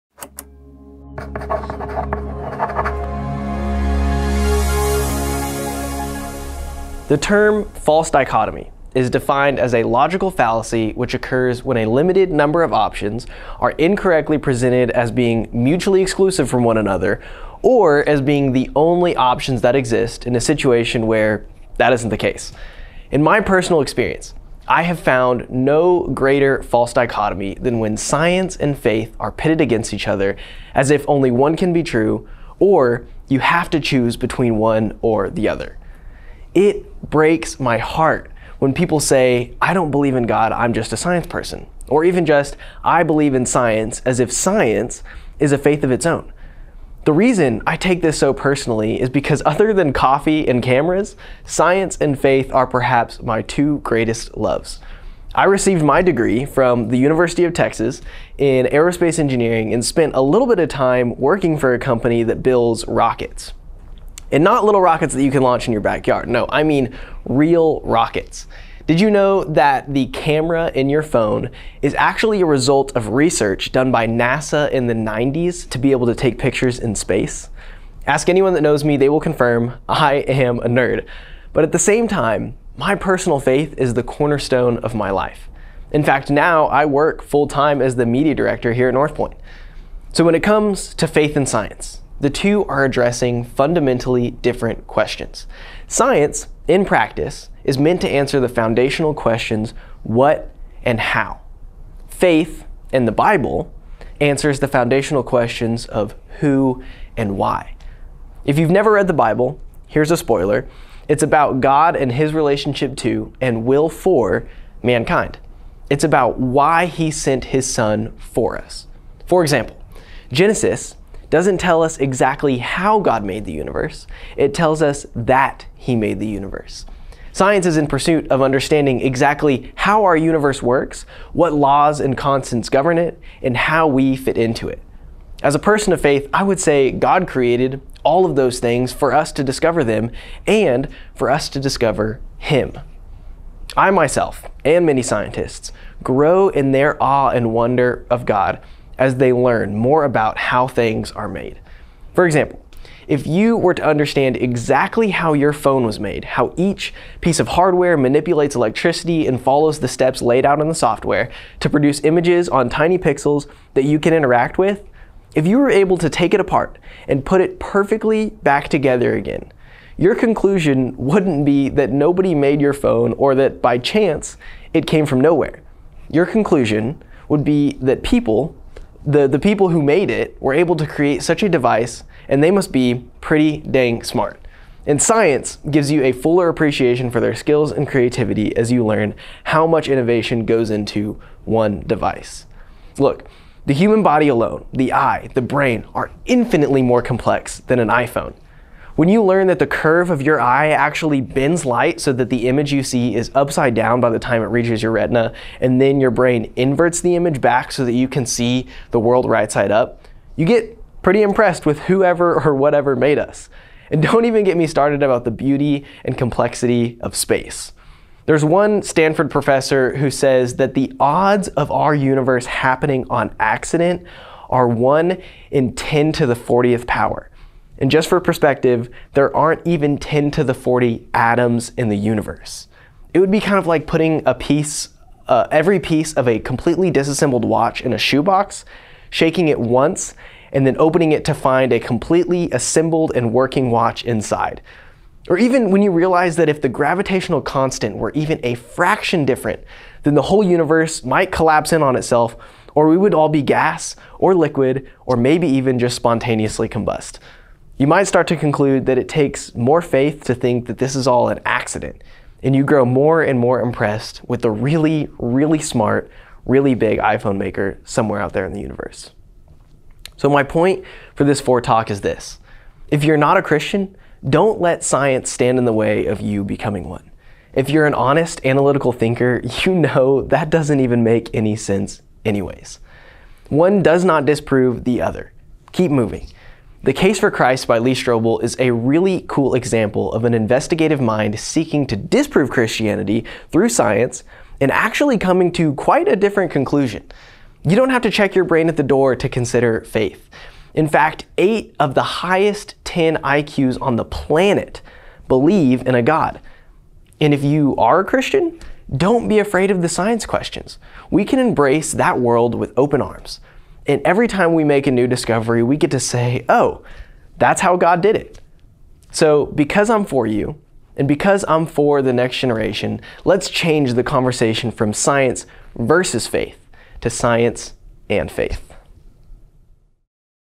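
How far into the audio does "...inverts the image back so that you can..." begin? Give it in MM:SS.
03:26.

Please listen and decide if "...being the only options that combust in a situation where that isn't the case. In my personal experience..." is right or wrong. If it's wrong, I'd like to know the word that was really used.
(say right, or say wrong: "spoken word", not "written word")
wrong: "exist", not "combust".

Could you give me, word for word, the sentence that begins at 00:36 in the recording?
It breaks my heart when people say, I don't believe in God, I'm just a science person.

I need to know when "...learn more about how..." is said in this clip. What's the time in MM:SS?
02:29.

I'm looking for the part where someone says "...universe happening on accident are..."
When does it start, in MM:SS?
03:41.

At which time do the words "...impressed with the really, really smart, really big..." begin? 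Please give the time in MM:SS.
04:23.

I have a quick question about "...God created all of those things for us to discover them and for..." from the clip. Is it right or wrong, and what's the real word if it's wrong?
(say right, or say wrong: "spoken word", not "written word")
right.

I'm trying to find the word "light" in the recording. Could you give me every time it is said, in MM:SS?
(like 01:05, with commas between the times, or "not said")
03:21.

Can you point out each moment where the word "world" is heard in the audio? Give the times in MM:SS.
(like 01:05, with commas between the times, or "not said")
03:28, 05:12.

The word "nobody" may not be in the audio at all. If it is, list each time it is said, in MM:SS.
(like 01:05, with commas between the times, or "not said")
02:51.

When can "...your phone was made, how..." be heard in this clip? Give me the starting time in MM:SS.
02:35.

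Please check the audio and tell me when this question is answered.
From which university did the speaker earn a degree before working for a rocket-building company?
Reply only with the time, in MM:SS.
00:56.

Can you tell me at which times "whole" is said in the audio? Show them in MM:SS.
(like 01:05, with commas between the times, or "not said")
04:10.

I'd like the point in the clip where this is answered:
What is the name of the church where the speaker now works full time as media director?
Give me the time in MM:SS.
01:28.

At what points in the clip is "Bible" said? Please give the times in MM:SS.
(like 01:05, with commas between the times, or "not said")
01:43, 01:49.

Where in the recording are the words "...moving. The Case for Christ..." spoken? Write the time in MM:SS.
04:45.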